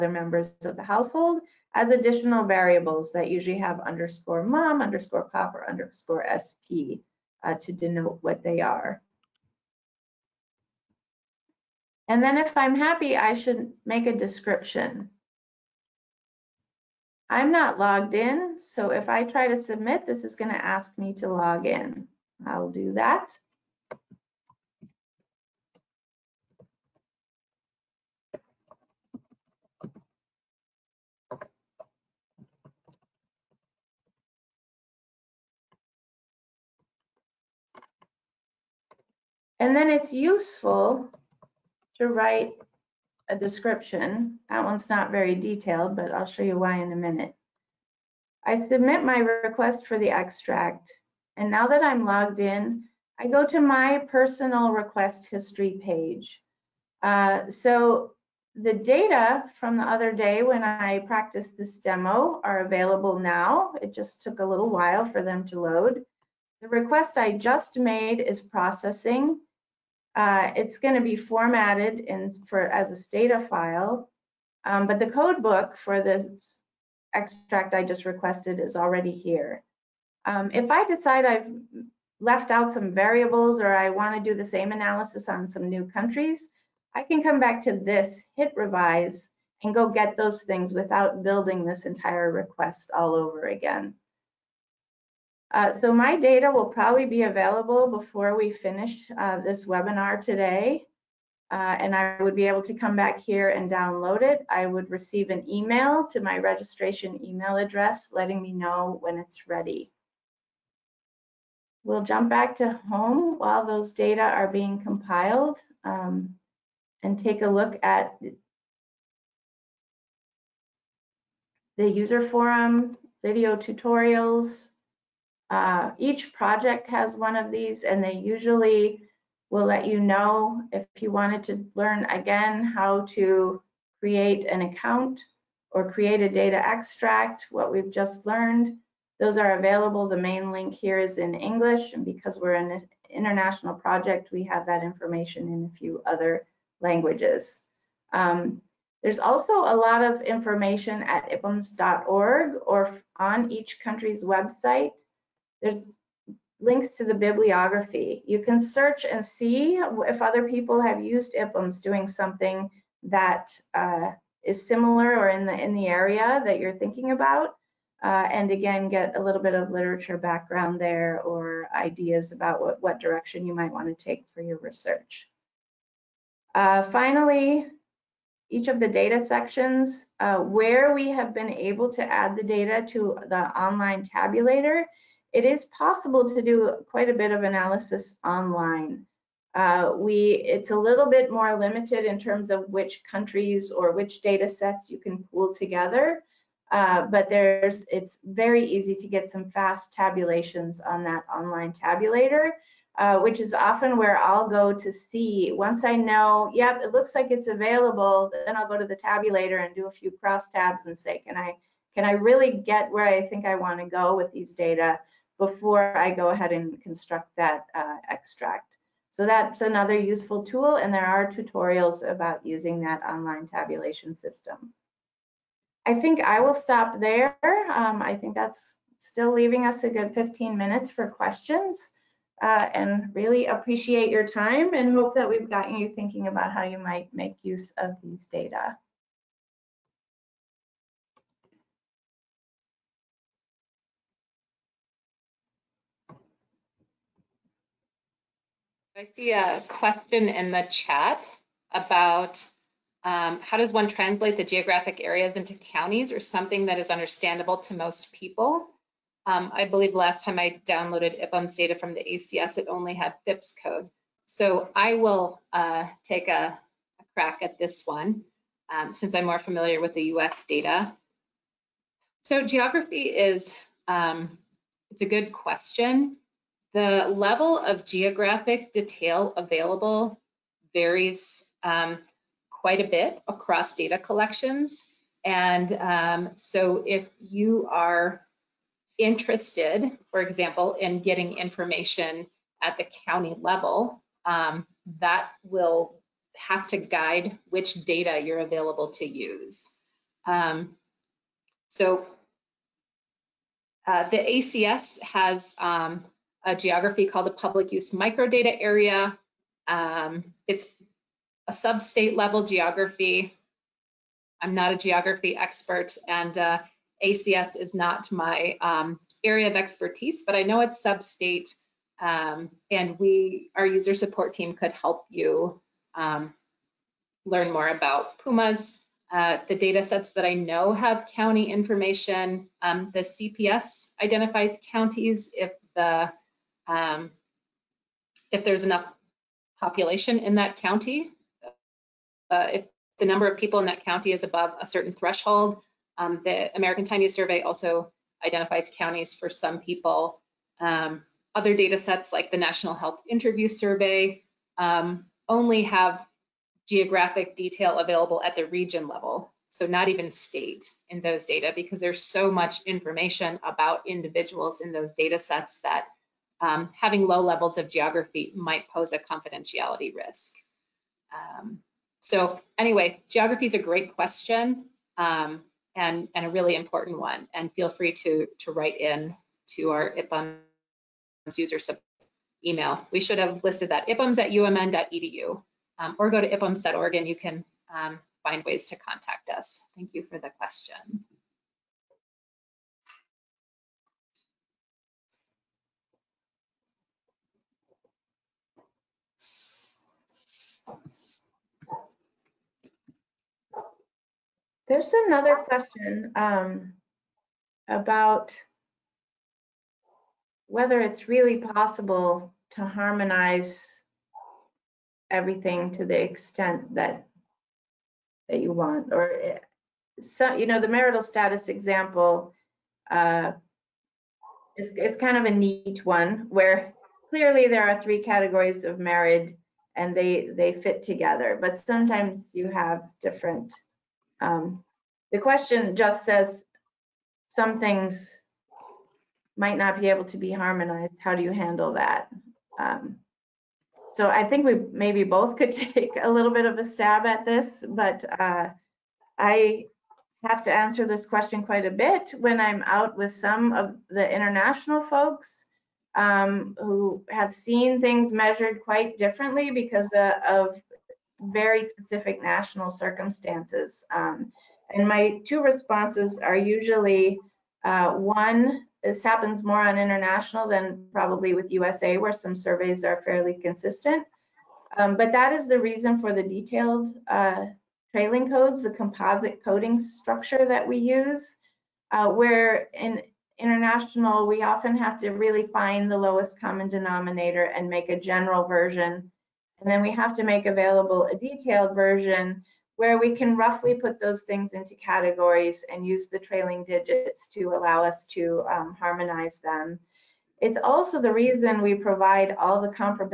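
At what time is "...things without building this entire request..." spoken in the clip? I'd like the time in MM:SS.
01:30.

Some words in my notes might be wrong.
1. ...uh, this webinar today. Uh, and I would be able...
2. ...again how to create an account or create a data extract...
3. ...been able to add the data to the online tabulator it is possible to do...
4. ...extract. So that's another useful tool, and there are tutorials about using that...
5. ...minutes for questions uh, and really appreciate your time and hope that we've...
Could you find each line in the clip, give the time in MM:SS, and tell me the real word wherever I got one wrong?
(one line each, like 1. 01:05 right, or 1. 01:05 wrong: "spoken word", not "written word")
1. 01:39 right
2. 02:12 right
3. 03:01 right
4. 03:38 right
5. 03:50 right.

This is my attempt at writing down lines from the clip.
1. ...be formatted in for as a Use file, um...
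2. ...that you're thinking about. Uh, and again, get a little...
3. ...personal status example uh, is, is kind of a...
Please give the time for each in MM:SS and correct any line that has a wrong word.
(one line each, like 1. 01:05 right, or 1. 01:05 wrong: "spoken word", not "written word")
1. 01:11 wrong: "Stata", not "Use"
2. 02:46 right
3. 07:00 wrong: "marital", not "personal".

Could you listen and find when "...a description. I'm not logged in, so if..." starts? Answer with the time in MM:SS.
00:14.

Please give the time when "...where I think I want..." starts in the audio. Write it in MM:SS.
03:32.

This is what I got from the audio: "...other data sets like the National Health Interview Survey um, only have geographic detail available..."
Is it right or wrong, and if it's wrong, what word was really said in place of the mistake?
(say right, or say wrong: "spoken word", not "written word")
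right.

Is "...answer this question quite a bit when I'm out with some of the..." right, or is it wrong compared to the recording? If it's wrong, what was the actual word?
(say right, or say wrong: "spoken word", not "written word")
right.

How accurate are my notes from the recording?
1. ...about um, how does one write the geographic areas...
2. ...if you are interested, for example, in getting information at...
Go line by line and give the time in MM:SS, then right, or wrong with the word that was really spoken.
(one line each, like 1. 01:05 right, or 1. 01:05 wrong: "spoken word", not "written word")
1. 04:11 wrong: "translate", not "write"
2. 04:46 right.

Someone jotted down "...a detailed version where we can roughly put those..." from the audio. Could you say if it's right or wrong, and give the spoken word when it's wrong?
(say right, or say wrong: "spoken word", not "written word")
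right.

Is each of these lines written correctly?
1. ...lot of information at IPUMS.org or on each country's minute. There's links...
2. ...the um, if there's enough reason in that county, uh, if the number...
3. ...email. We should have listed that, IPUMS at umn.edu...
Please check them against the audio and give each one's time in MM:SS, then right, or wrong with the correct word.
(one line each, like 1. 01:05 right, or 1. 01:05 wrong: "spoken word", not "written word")
1. 02:29 wrong: "website", not "minute"
2. 05:35 wrong: "population", not "reason"
3. 06:22 right.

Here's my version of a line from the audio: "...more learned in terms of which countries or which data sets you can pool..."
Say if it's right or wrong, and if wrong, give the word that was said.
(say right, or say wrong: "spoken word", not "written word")
wrong: "limited", not "learned".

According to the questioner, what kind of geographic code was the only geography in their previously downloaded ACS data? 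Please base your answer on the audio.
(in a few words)
FIPS code.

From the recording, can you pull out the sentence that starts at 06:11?
Um, so anyway, geography is a great question um, and, and a really important one.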